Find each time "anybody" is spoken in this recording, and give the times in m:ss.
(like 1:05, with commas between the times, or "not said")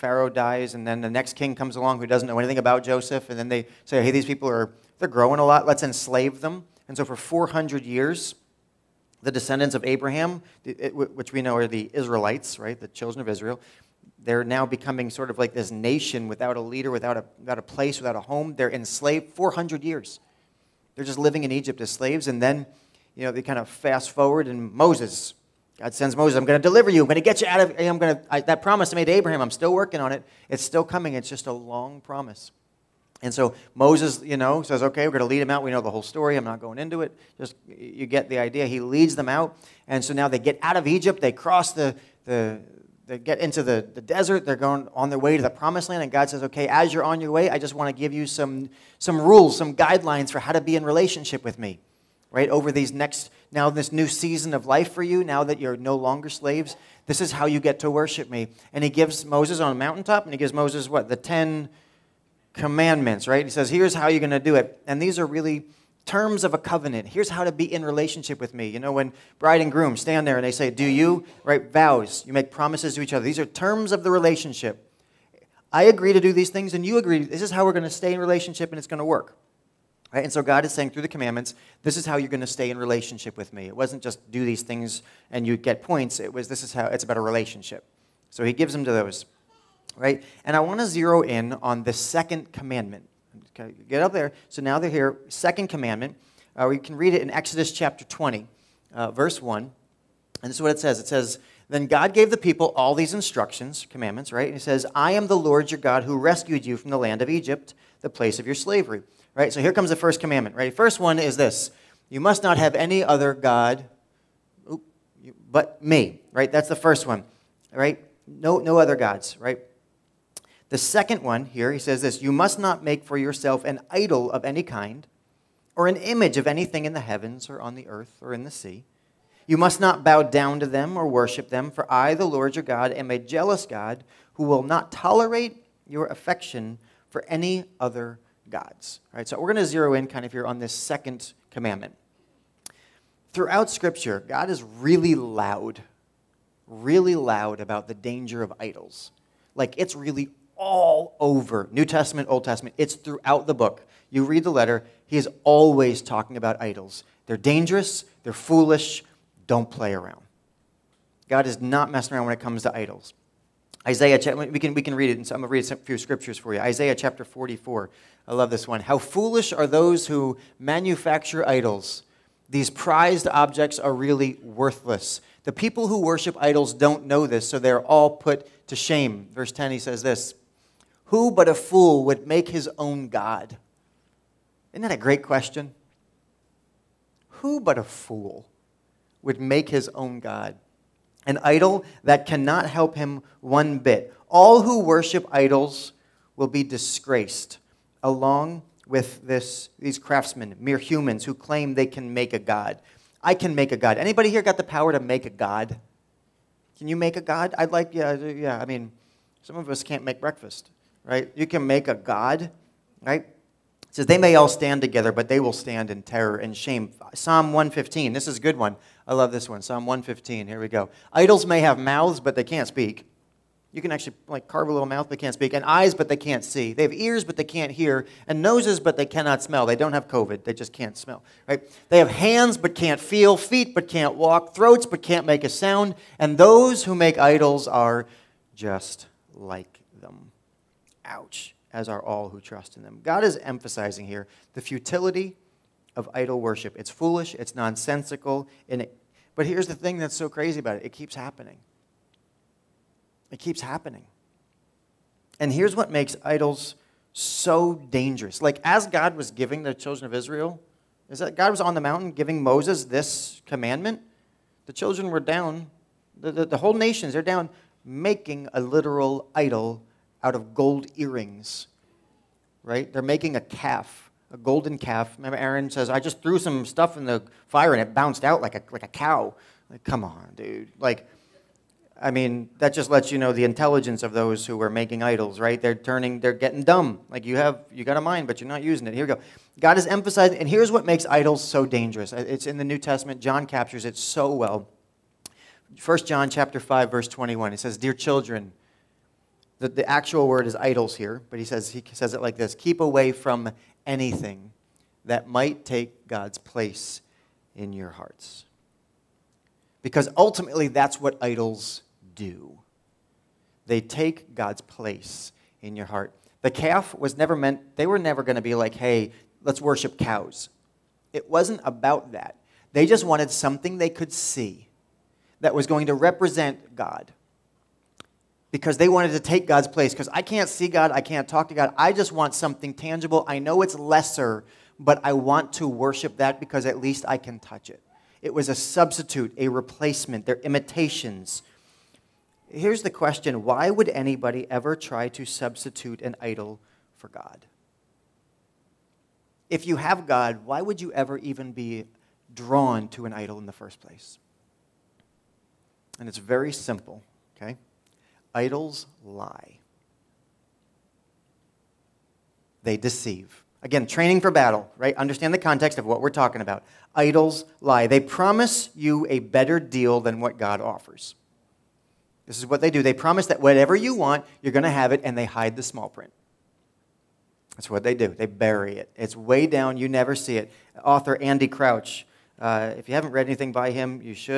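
3:23, 5:43.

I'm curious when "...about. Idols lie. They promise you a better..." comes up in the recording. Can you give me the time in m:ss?
6:06.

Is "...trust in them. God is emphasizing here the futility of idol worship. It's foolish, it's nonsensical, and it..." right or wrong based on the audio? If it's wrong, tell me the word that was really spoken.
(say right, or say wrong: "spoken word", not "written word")
right.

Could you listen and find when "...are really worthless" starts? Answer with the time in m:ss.
2:53.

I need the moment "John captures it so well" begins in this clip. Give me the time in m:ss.
4:53.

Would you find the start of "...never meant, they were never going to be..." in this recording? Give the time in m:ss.
5:17.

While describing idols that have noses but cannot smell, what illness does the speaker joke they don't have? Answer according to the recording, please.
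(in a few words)
COVID.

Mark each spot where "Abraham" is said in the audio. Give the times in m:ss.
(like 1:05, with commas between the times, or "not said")
0:09, 0:29.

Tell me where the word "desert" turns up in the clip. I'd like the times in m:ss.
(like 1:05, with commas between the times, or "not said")
0:44.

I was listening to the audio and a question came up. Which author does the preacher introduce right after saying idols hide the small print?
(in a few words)
Andy Crouch.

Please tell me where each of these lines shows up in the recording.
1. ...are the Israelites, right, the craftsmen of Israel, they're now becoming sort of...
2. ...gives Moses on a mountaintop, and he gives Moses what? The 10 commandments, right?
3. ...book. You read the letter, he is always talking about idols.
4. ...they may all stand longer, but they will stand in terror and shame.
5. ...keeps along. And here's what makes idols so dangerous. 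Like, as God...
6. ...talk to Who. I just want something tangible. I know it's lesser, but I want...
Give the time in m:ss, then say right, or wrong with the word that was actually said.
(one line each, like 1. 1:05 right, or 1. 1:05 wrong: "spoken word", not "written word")
1. 0:11 wrong: "children", not "craftsmen"
2. 0:58 right
3. 2:33 right
4. 3:34 wrong: "together", not "longer"
5. 4:13 wrong: "happening", not "along"
6. 5:31 wrong: "God", not "Who".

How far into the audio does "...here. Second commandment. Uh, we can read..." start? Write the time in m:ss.
1:34.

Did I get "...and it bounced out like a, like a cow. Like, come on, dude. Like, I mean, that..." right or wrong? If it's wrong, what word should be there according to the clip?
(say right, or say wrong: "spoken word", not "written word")
right.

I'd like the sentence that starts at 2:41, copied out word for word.
God is not messing around when it comes to idols.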